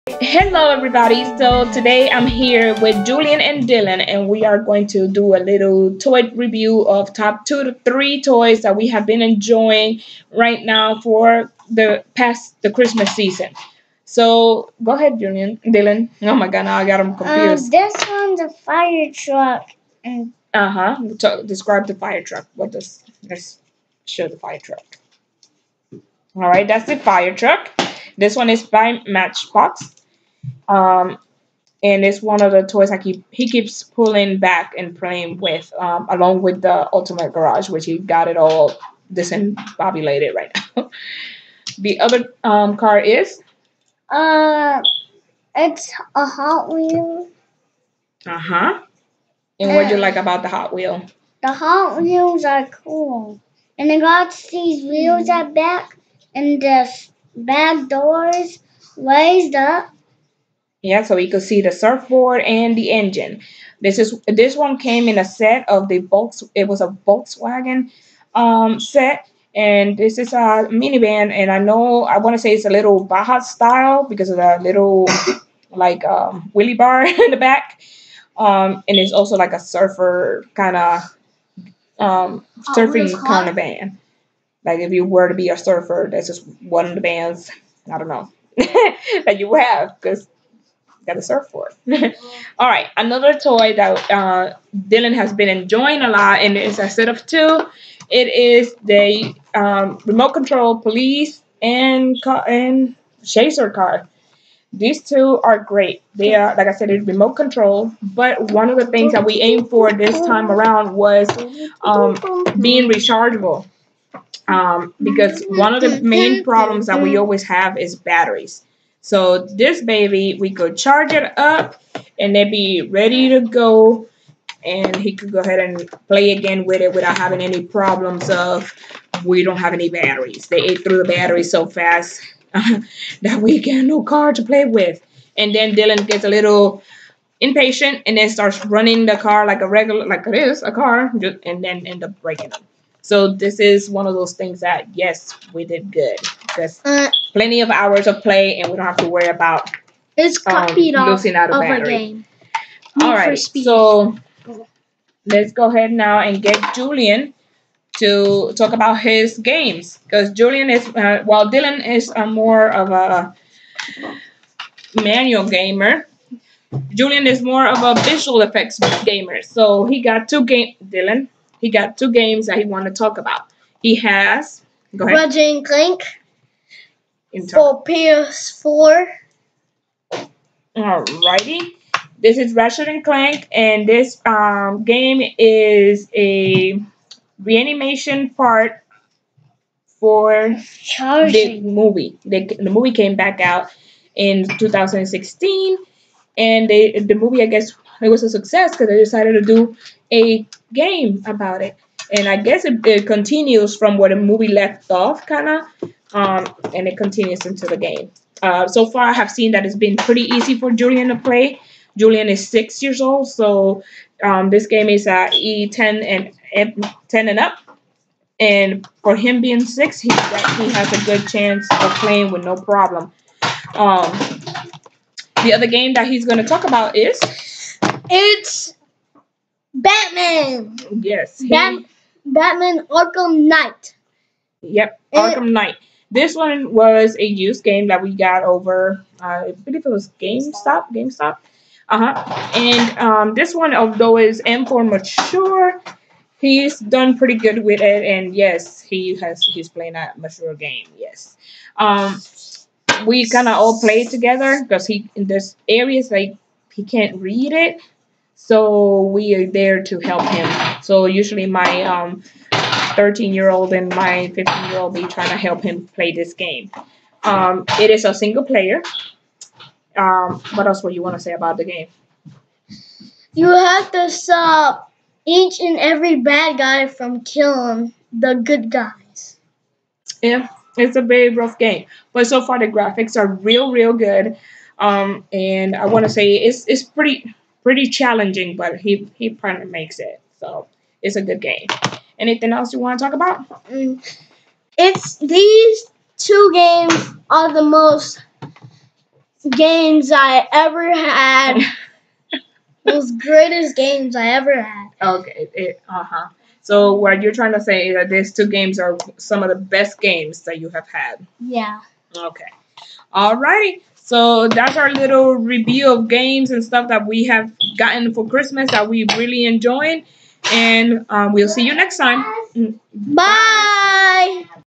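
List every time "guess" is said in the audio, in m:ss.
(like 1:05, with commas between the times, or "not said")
3:17, 3:22.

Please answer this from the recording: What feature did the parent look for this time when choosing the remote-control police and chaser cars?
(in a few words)
Being rechargeable.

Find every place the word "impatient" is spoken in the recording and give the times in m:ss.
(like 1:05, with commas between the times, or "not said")
2:17.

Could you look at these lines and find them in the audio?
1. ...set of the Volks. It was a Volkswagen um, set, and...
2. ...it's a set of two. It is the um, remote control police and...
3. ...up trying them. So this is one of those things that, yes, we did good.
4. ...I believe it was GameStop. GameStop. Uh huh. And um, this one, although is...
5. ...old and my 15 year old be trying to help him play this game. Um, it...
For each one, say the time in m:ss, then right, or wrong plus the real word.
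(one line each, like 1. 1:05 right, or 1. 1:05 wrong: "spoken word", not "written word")
1. 1:05 right
2. 1:36 right
3. 2:22 wrong: "breaking", not "trying"
4. 3:59 right
5. 4:23 right.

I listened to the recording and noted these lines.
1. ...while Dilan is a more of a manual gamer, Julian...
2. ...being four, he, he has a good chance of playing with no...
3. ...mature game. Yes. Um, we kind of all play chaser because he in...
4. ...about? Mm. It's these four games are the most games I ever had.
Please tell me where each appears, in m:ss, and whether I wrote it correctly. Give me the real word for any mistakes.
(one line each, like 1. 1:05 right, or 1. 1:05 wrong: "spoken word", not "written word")
1. 2:41 right
2. 3:39 wrong: "six", not "four"
3. 4:10 wrong: "together", not "chaser"
4. 4:53 wrong: "two", not "four".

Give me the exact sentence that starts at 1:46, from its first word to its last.
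They are, like I said, it's remote control.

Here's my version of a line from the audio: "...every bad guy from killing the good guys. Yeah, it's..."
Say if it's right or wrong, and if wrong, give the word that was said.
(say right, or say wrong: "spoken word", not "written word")
right.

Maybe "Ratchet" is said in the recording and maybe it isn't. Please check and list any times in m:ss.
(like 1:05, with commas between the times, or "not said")
2:55, 3:02.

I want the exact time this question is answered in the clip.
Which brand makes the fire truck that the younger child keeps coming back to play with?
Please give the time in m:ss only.
0:29.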